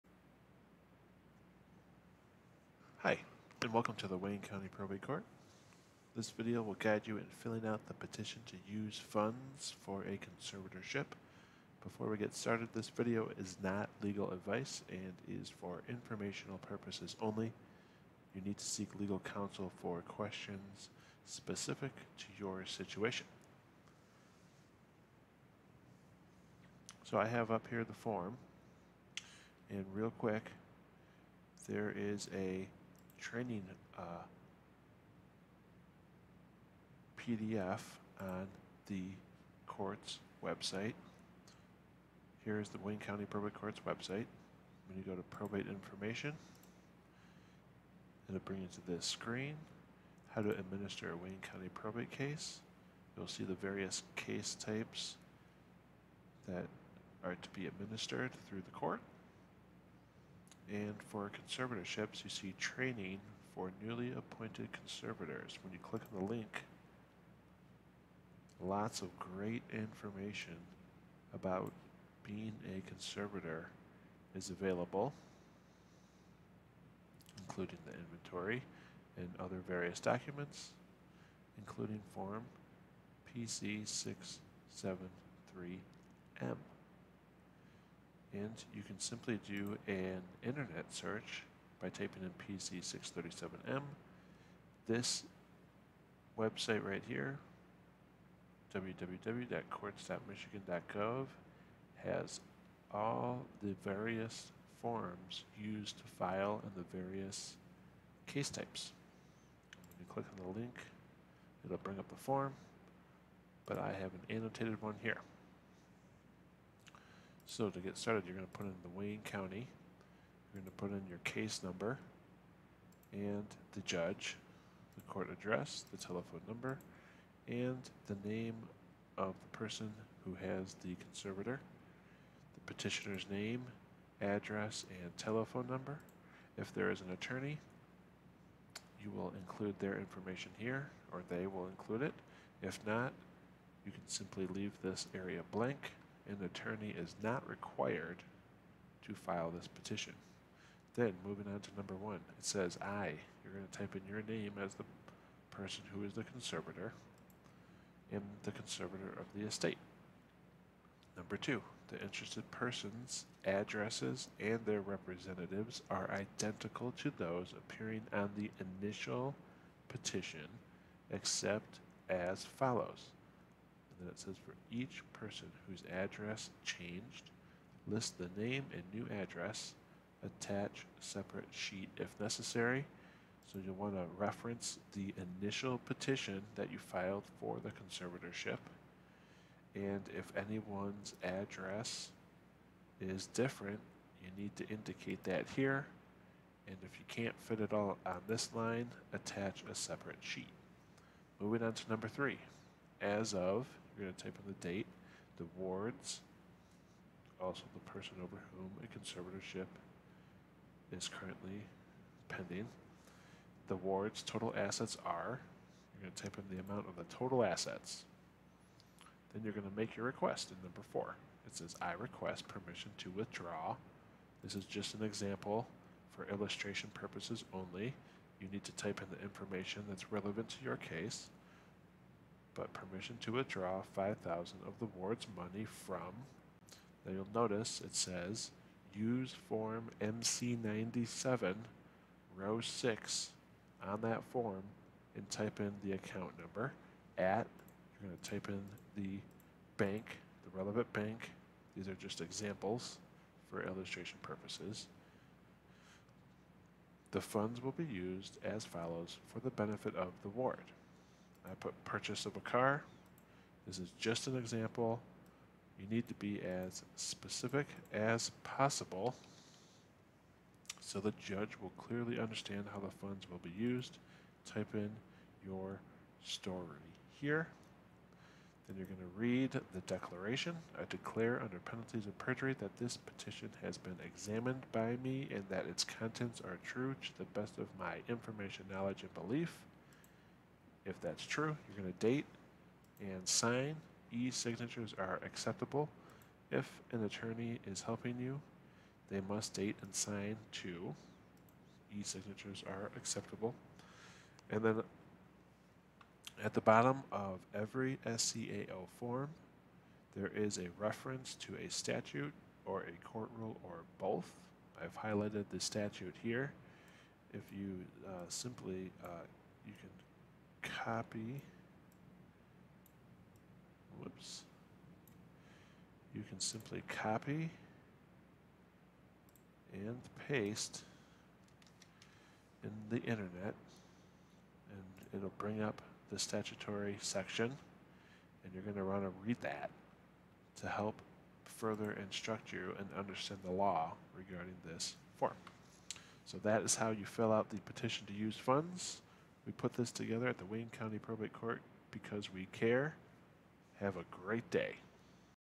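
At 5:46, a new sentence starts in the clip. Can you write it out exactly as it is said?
So that is how you fill out the petition to use funds.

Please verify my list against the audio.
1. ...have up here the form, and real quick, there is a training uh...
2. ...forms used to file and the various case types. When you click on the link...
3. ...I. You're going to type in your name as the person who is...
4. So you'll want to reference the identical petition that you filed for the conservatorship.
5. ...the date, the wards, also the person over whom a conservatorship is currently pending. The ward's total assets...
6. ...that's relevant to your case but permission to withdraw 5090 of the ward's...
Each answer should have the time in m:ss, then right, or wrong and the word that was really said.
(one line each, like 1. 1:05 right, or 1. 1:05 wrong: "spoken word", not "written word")
1. 0:27 right
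2. 1:44 right
3. 2:32 right
4. 3:03 wrong: "initial", not "identical"
5. 3:24 right
6. 3:49 wrong: "5000", not "5090".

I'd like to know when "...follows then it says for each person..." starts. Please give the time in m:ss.
2:52.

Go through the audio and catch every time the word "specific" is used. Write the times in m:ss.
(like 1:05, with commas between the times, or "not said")
0:21, 4:26.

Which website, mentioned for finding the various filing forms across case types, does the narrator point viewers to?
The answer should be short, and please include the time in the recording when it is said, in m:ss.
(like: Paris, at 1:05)
www.courts.michigan.gov, at 1:38.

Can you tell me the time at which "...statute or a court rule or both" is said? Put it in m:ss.
5:11.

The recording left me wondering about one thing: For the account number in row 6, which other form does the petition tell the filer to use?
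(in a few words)
MC 97.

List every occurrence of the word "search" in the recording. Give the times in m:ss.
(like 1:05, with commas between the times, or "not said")
1:30.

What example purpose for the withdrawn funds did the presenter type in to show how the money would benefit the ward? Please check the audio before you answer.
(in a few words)
purchase of a car.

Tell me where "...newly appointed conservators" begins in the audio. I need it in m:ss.
1:03.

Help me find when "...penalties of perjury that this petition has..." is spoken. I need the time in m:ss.
4:41.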